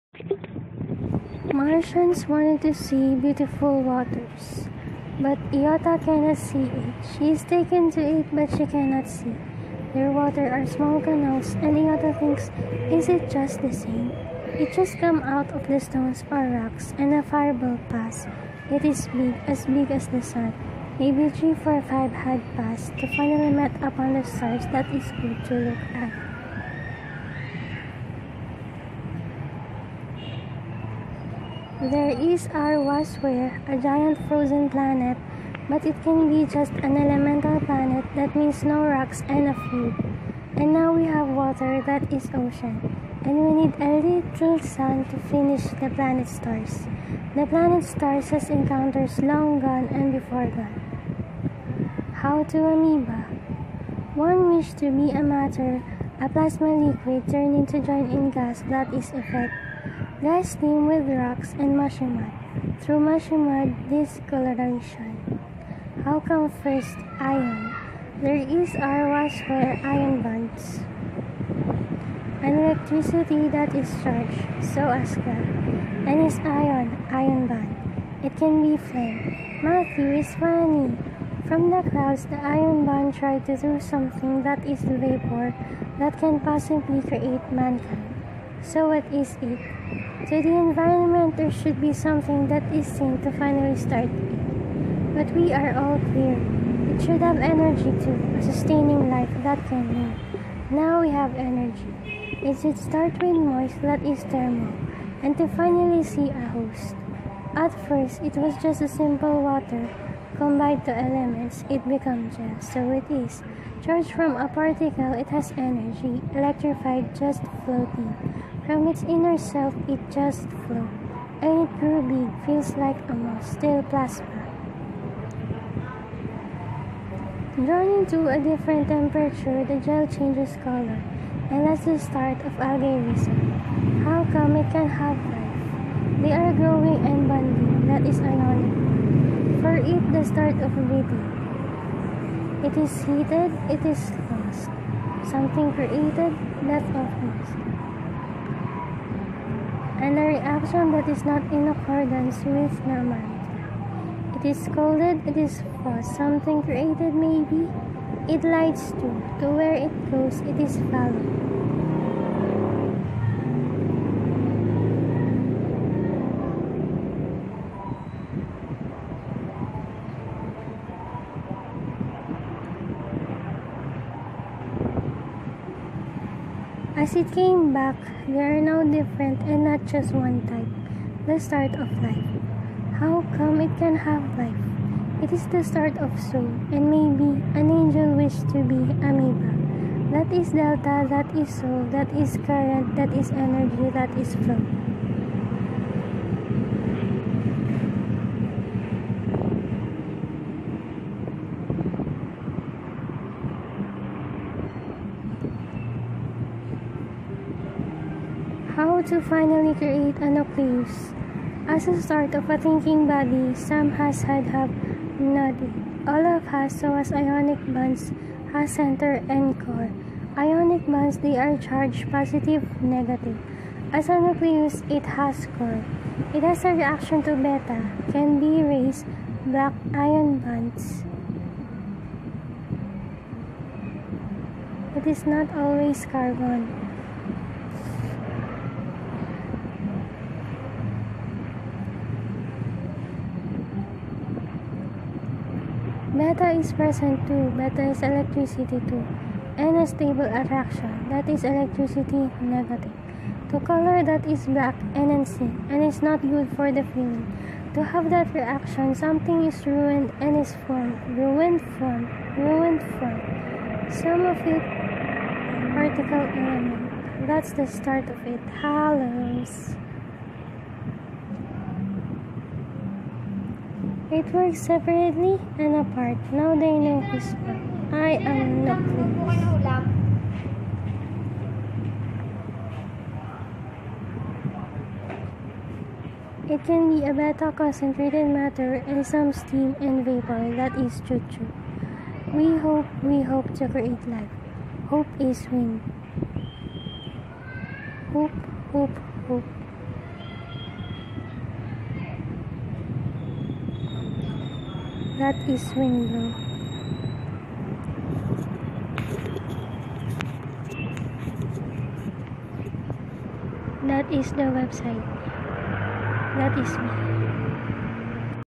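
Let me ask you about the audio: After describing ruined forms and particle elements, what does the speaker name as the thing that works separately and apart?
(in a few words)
Halos.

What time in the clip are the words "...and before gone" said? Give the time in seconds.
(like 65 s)
49 s.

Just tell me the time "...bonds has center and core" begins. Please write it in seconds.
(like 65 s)
217 s.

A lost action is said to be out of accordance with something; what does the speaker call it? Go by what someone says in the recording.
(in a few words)
Namantra.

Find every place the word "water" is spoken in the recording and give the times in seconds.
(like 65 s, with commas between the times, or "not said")
3 s, 10 s, 41 s, 109 s.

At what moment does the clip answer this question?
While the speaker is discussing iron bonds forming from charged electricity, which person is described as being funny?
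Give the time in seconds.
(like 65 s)
79 s.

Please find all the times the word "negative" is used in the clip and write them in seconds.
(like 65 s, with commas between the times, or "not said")
222 s, 252 s.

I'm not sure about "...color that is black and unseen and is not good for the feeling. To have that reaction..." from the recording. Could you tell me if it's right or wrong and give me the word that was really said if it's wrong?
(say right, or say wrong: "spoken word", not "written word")
right.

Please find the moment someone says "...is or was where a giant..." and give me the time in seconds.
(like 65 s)
32 s.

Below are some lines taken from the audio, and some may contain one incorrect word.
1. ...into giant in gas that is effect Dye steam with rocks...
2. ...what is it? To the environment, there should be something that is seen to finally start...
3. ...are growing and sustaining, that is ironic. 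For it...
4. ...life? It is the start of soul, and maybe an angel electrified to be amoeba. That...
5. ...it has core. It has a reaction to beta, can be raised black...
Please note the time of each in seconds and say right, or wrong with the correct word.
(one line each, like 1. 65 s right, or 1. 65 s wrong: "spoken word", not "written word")
1. 57 s right
2. 88 s right
3. 136 s wrong: "bonding", not "sustaining"
4. 184 s wrong: "wished", not "electrified"
5. 224 s right.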